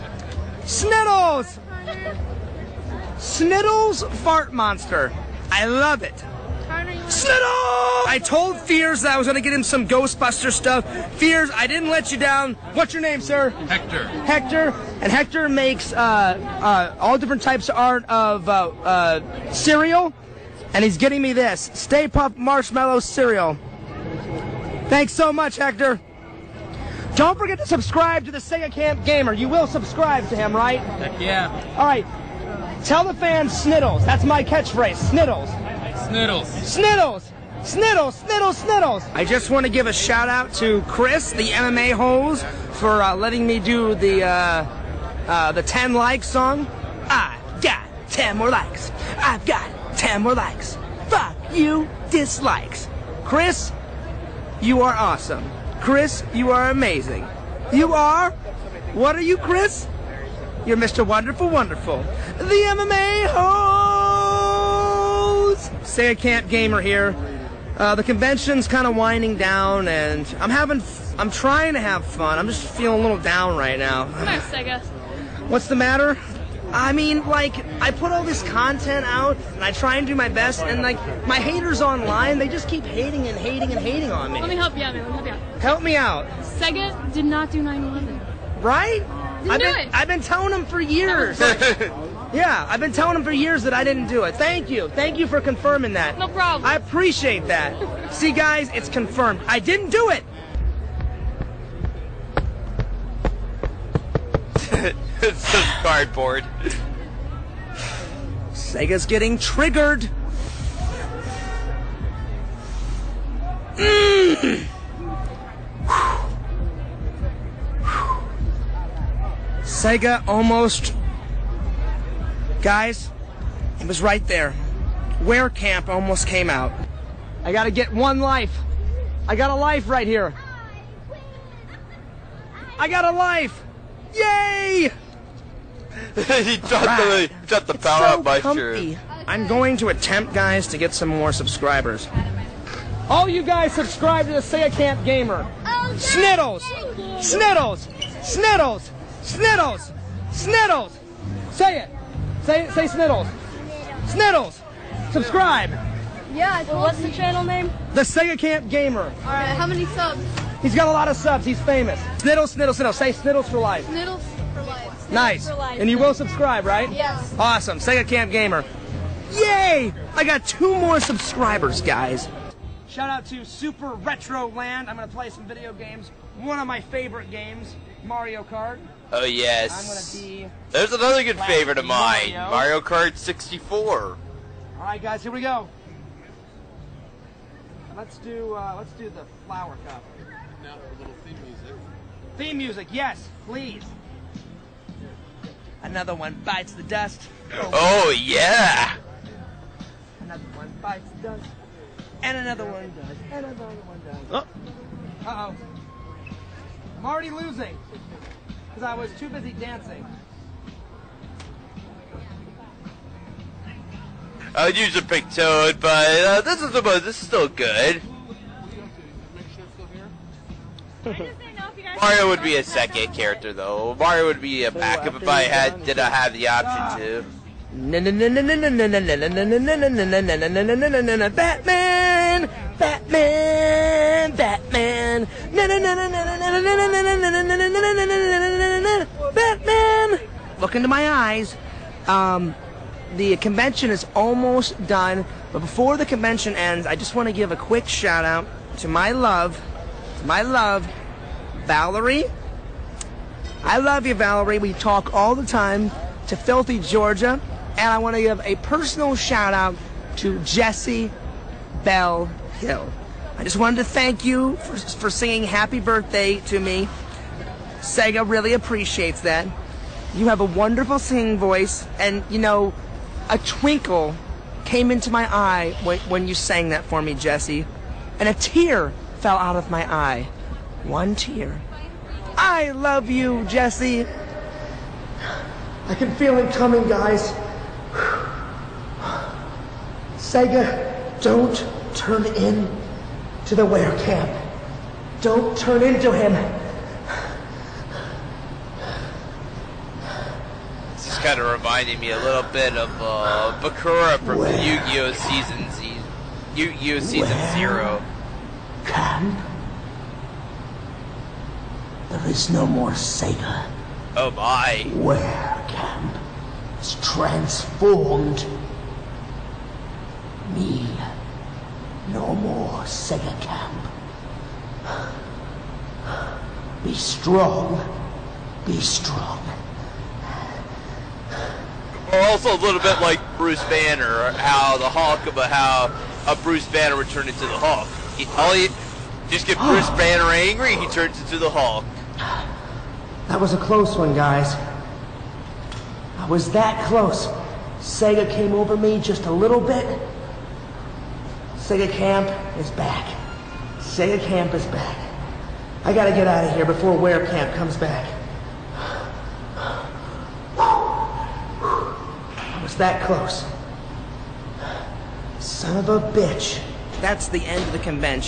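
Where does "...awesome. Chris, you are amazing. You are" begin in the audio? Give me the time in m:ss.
0:54.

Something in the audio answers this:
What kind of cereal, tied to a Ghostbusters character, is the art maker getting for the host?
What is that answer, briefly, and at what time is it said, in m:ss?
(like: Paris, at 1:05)
Stay Puft Marshmallow Cereal, at 0:21.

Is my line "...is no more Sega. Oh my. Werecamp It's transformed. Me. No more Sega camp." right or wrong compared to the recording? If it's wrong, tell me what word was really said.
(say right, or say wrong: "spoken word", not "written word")
right.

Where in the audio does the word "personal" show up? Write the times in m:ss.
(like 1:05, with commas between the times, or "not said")
4:18.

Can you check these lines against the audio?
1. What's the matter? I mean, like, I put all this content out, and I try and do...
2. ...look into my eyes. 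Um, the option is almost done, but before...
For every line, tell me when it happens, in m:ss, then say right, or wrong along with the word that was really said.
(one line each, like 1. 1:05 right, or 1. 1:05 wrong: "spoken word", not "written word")
1. 1:15 right
2. 4:00 wrong: "convention", not "option".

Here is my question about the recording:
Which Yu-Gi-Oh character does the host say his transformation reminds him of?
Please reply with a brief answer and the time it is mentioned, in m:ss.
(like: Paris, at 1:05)
Bakura, at 5:03.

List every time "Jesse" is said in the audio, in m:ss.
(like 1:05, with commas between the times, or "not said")
4:20, 4:37, 4:43.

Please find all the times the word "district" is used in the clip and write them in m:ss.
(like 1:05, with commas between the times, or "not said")
not said.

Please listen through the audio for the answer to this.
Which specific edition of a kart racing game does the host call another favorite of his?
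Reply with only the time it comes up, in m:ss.
3:02.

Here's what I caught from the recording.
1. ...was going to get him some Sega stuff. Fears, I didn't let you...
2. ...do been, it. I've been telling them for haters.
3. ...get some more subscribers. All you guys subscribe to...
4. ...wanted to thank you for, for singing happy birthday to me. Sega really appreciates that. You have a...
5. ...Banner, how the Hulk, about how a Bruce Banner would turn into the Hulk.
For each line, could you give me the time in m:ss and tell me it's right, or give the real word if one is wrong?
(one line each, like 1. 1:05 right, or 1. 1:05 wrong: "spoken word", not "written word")
1. 0:09 wrong: "Ghostbuster", not "Sega"
2. 1:29 wrong: "years", not "haters"
3. 2:20 right
4. 4:23 right
5. 5:33 right.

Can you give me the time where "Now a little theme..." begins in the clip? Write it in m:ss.
3:10.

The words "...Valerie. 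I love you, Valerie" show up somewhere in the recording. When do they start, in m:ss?
4:11.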